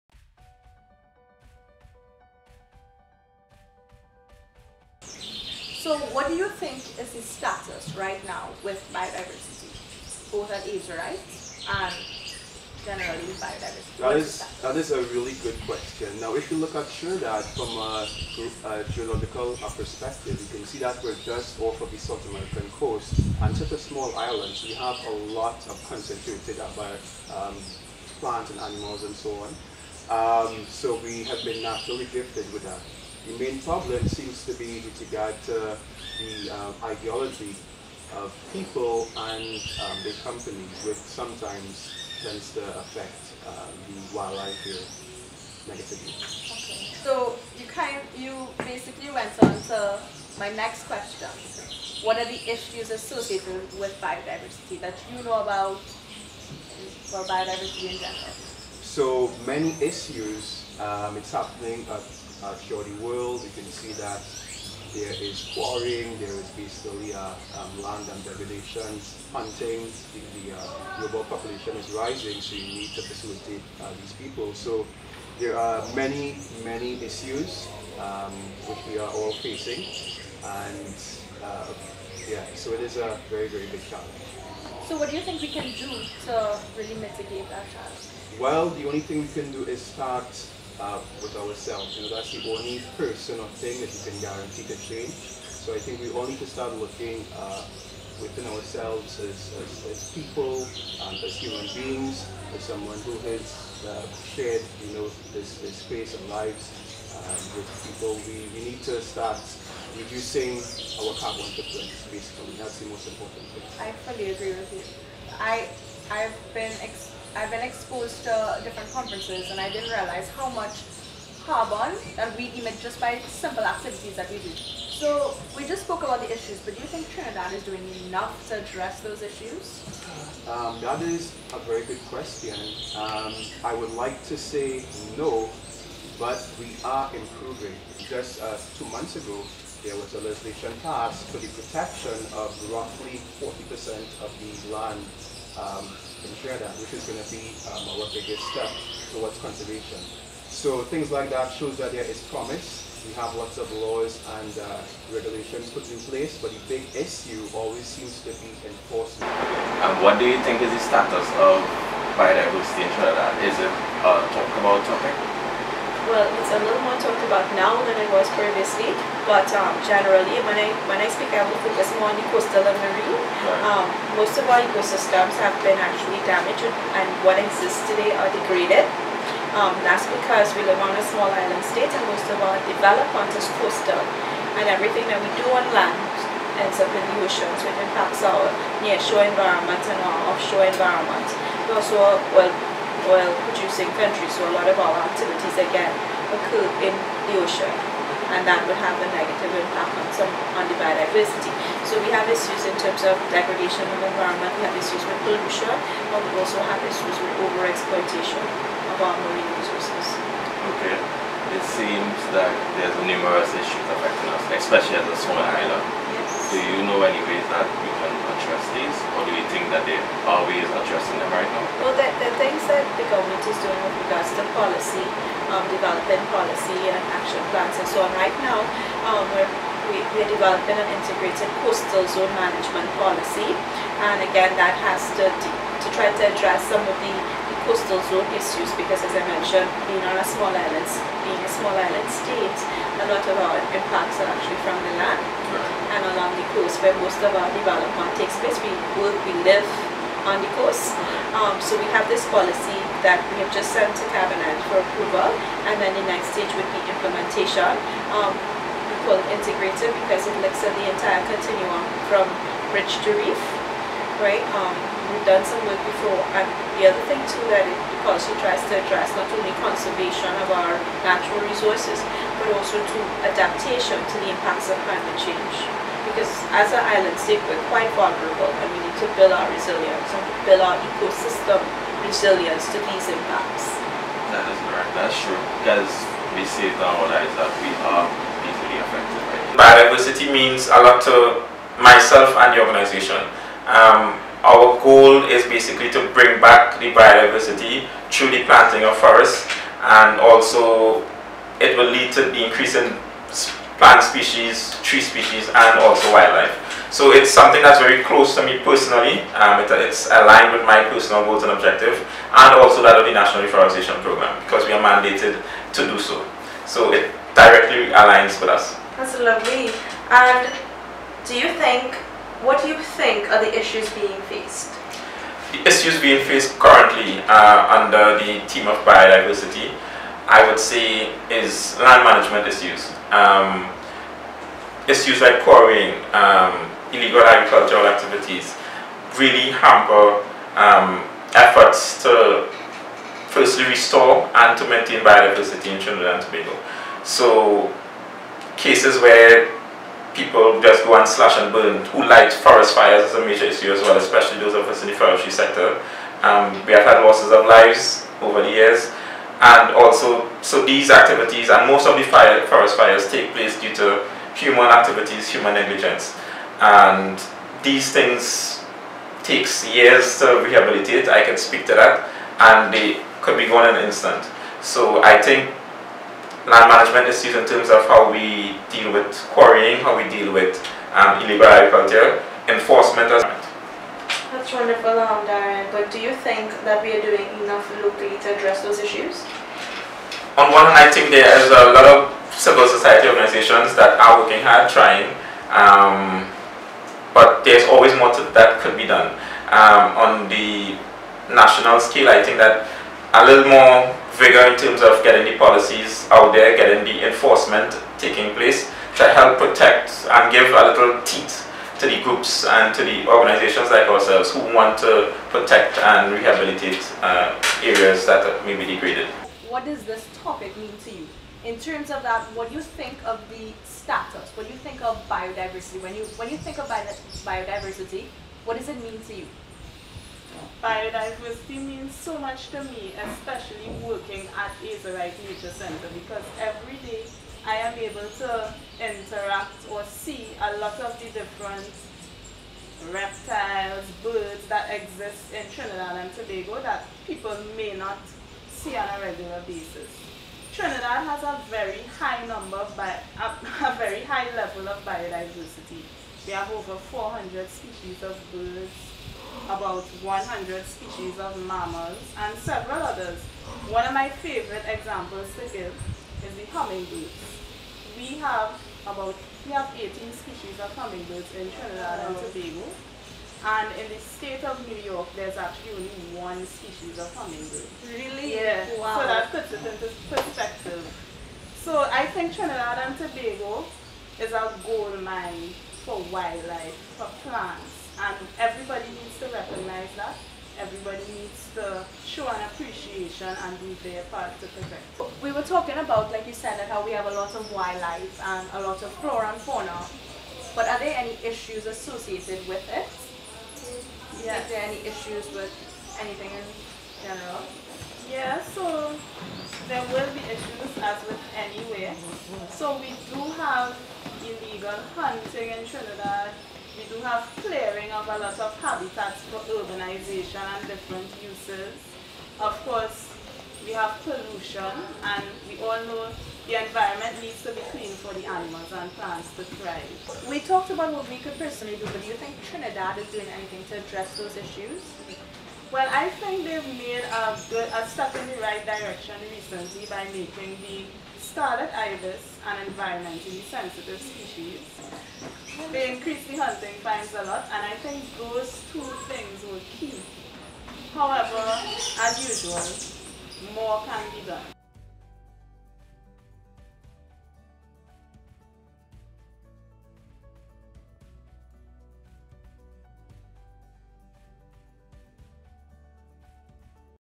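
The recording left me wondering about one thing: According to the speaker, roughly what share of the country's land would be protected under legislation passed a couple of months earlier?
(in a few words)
40%.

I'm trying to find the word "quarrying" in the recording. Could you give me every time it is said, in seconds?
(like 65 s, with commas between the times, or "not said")
65 s, 335 s, 379 s.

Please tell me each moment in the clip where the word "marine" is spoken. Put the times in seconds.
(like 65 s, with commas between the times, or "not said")
172 s, 209 s.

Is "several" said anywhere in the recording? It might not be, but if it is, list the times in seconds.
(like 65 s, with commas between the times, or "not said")
462 s.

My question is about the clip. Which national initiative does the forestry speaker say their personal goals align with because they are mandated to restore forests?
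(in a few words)
National Reforestation Program.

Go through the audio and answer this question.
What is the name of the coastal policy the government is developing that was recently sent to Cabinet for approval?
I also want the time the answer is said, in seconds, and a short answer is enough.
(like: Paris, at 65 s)
integrated coastal zone management policy, at 230 s.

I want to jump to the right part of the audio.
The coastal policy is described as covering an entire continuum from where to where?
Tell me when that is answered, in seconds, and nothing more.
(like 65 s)
262 s.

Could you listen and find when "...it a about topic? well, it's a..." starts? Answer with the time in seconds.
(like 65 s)
163 s.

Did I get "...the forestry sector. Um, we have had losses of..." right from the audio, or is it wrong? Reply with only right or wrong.
right.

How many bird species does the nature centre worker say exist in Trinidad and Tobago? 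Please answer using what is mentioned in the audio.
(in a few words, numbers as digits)
over 400.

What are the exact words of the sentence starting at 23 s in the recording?
And such a small island, so we have a lot of concentrated about uh, um, plants and animals and so on.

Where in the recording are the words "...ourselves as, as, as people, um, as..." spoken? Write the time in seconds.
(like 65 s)
98 s.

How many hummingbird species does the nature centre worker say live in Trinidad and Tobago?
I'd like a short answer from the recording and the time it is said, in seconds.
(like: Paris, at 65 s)
18, at 469 s.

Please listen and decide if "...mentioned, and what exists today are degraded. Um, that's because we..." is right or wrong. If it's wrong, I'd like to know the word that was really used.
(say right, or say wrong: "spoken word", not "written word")
wrong: "damaged", not "mentioned".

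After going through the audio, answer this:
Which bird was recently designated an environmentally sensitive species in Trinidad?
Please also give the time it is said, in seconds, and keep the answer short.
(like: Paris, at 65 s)
scarlet ibis, at 541 s.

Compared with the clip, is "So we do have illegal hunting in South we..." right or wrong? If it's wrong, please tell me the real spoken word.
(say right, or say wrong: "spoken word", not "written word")
wrong: "Trinidad", not "South".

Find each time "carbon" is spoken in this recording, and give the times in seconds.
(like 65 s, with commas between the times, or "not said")
111 s, 121 s.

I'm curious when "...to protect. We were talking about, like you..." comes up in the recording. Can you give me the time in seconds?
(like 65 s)
494 s.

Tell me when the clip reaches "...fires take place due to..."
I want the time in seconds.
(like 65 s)
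362 s.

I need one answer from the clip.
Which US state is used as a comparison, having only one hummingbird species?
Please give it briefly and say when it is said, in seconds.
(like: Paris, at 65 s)
New York, at 474 s.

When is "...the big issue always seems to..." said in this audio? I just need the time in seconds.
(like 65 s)
156 s.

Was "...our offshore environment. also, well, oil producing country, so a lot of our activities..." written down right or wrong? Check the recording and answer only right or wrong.
right.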